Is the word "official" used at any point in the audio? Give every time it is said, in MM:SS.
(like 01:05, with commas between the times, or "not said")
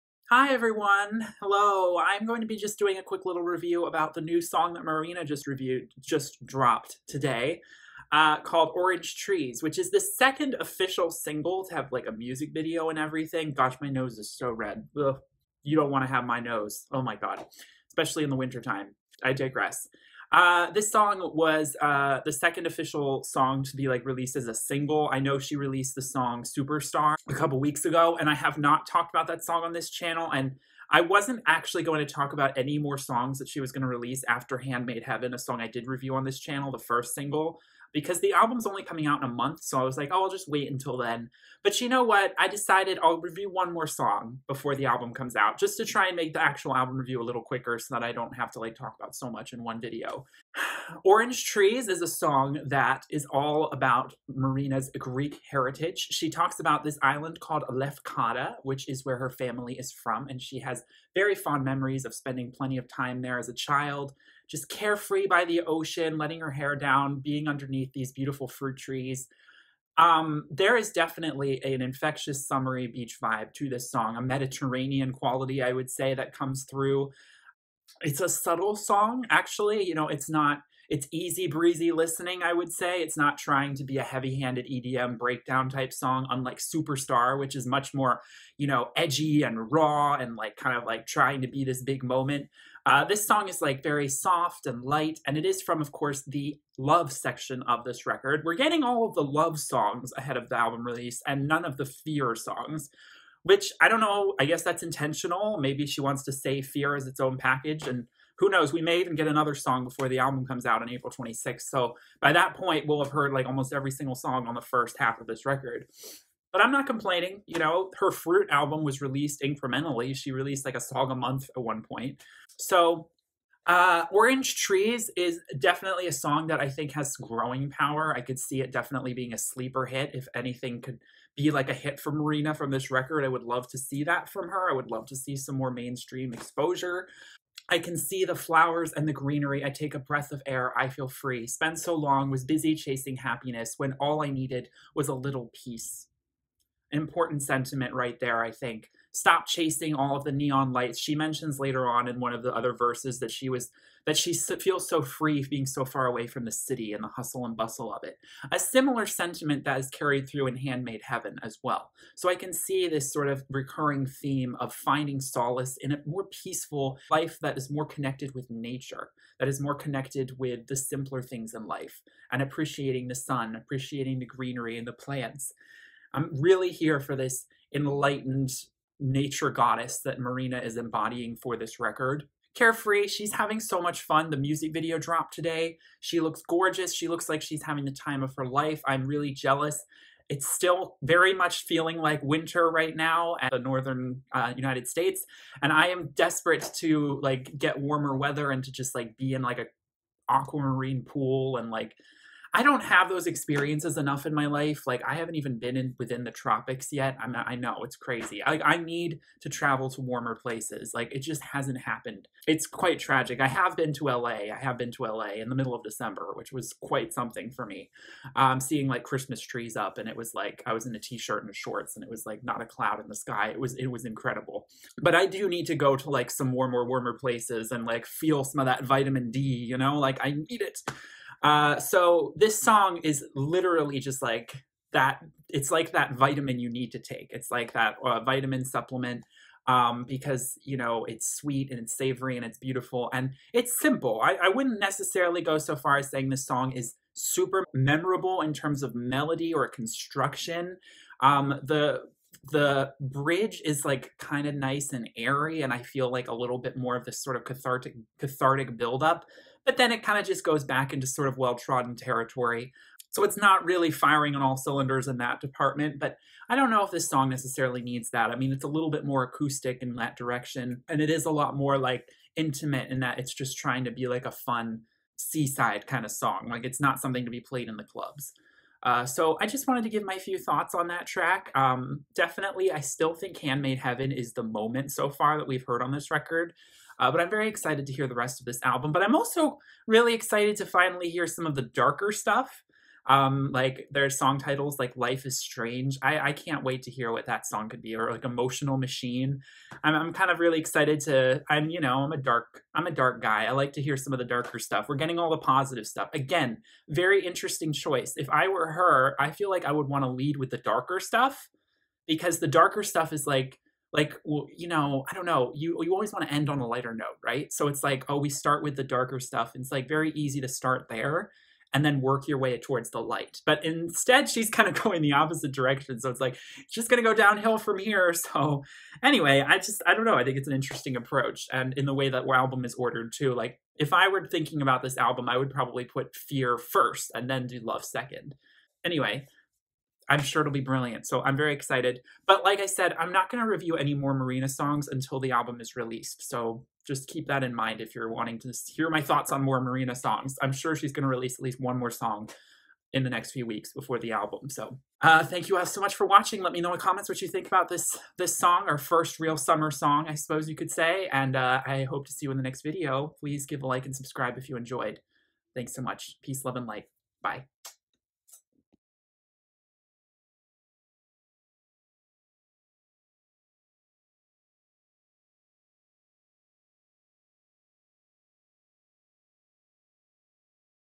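00:10, 00:22.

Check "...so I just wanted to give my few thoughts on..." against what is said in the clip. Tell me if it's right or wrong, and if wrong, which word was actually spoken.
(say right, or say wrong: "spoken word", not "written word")
right.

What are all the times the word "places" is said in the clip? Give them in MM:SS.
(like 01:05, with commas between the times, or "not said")
03:30, 03:47.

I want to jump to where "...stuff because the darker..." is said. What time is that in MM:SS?
05:10.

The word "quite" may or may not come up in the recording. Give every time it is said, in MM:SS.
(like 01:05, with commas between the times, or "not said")
03:32, 03:36.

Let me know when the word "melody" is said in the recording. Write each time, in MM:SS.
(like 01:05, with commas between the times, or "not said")
04:08.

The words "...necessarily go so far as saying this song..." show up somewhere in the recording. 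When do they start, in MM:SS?
04:04.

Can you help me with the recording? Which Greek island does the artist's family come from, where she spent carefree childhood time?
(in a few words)
Lefkada.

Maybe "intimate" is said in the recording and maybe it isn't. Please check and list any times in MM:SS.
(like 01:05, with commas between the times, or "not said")
04:32.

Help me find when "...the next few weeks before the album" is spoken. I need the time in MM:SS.
05:53.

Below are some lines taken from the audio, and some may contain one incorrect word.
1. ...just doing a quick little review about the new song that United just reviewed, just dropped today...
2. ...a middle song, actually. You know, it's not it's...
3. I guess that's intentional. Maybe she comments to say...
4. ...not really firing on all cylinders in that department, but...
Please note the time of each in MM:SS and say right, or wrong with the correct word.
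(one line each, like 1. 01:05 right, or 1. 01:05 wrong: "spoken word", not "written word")
1. 00:02 wrong: "Marina", not "United"
2. 01:18 wrong: "subtle", not "middle"
3. 01:44 wrong: "wants", not "comments"
4. 04:23 right.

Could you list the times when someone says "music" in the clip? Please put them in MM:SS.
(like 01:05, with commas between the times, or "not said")
00:12, 03:04.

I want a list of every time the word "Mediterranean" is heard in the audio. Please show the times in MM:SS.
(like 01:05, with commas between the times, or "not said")
01:14.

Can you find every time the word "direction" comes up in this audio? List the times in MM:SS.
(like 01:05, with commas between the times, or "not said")
04:30, 05:25.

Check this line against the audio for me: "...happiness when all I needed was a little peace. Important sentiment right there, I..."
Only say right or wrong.
right.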